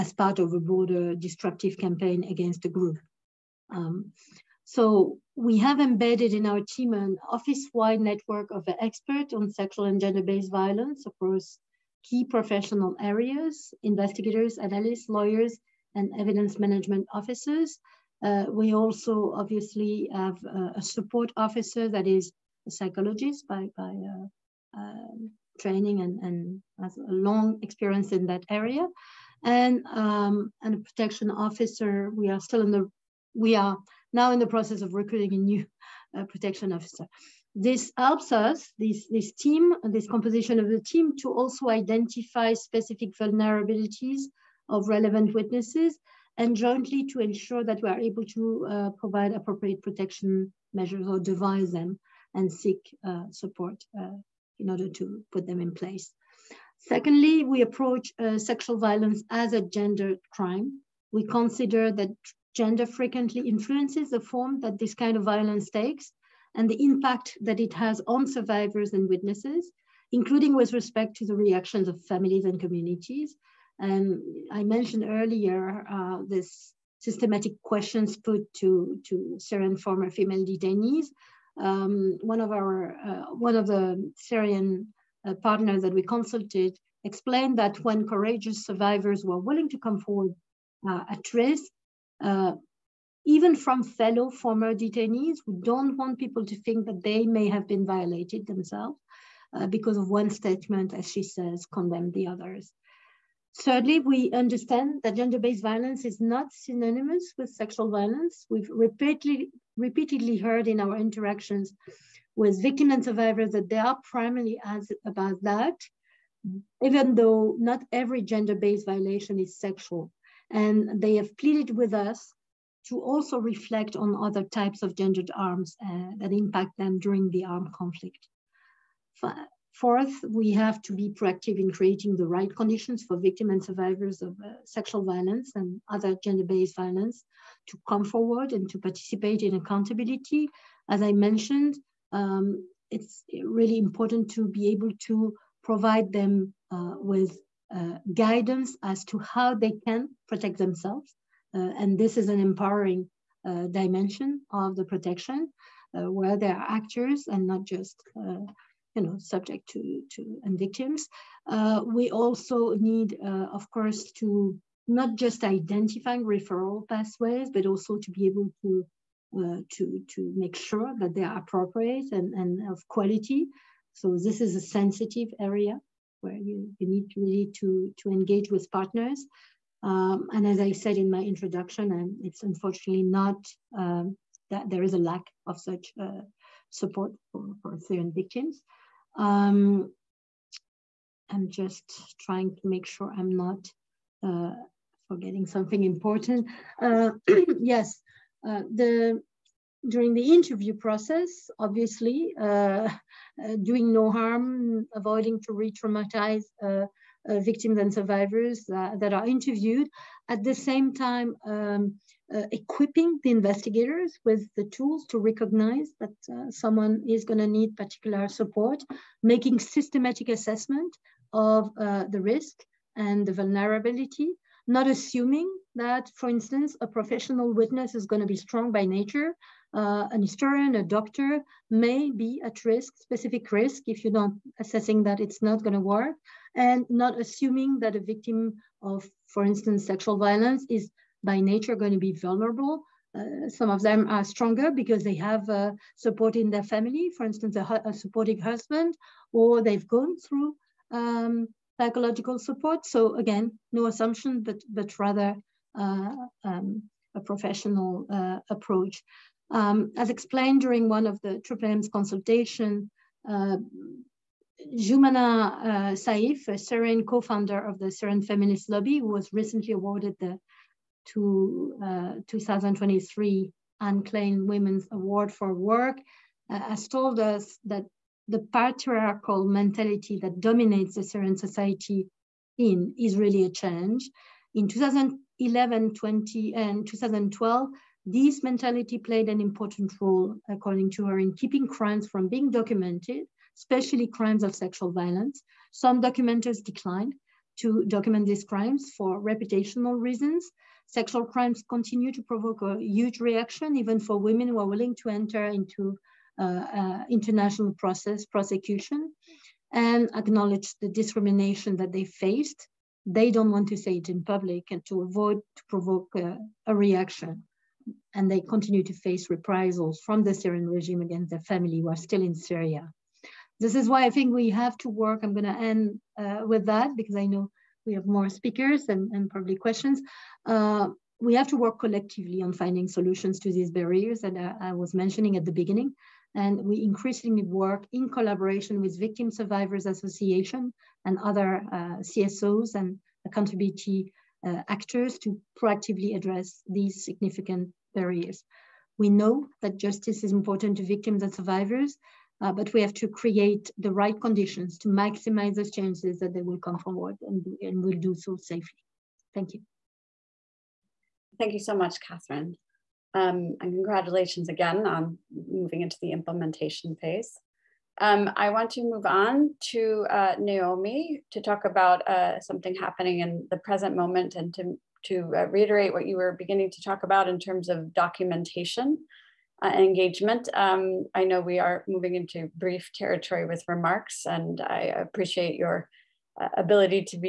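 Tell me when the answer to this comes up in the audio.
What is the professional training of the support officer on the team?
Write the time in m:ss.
0:22.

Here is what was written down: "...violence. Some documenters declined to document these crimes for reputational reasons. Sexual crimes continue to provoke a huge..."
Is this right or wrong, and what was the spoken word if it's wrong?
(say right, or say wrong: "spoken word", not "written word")
right.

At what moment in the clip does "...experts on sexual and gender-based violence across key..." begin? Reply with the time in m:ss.
0:08.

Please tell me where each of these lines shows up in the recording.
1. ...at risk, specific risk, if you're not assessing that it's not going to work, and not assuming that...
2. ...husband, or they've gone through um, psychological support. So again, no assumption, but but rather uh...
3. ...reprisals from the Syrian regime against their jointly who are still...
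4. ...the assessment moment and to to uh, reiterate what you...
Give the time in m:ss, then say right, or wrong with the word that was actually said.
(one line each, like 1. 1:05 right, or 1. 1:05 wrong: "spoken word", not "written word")
1. 3:52 right
2. 4:08 right
3. 5:19 wrong: "family", not "jointly"
4. 6:13 wrong: "present", not "assessment".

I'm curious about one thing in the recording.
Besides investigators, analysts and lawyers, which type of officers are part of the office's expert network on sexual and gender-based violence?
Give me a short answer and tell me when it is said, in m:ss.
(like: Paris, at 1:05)
Evidence management officers, at 0:16.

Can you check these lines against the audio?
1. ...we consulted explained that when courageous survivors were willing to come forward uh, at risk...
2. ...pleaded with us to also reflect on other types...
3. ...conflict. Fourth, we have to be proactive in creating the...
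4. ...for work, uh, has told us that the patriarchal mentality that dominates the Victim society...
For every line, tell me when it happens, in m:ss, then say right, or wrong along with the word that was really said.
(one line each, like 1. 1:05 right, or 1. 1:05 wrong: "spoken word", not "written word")
1. 1:25 right
2. 2:01 right
3. 2:07 right
4. 4:35 wrong: "Syrian", not "Victim".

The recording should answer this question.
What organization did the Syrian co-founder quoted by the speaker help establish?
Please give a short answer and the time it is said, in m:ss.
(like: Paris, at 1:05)
Syrian Feminist Lobby, at 4:27.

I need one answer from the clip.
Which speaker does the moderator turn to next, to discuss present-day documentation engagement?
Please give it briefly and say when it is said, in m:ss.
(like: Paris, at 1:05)
Naomi, at 6:10.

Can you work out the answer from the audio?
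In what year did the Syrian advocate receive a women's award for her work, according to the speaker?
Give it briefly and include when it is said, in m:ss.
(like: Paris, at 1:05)
2023, at 4:32.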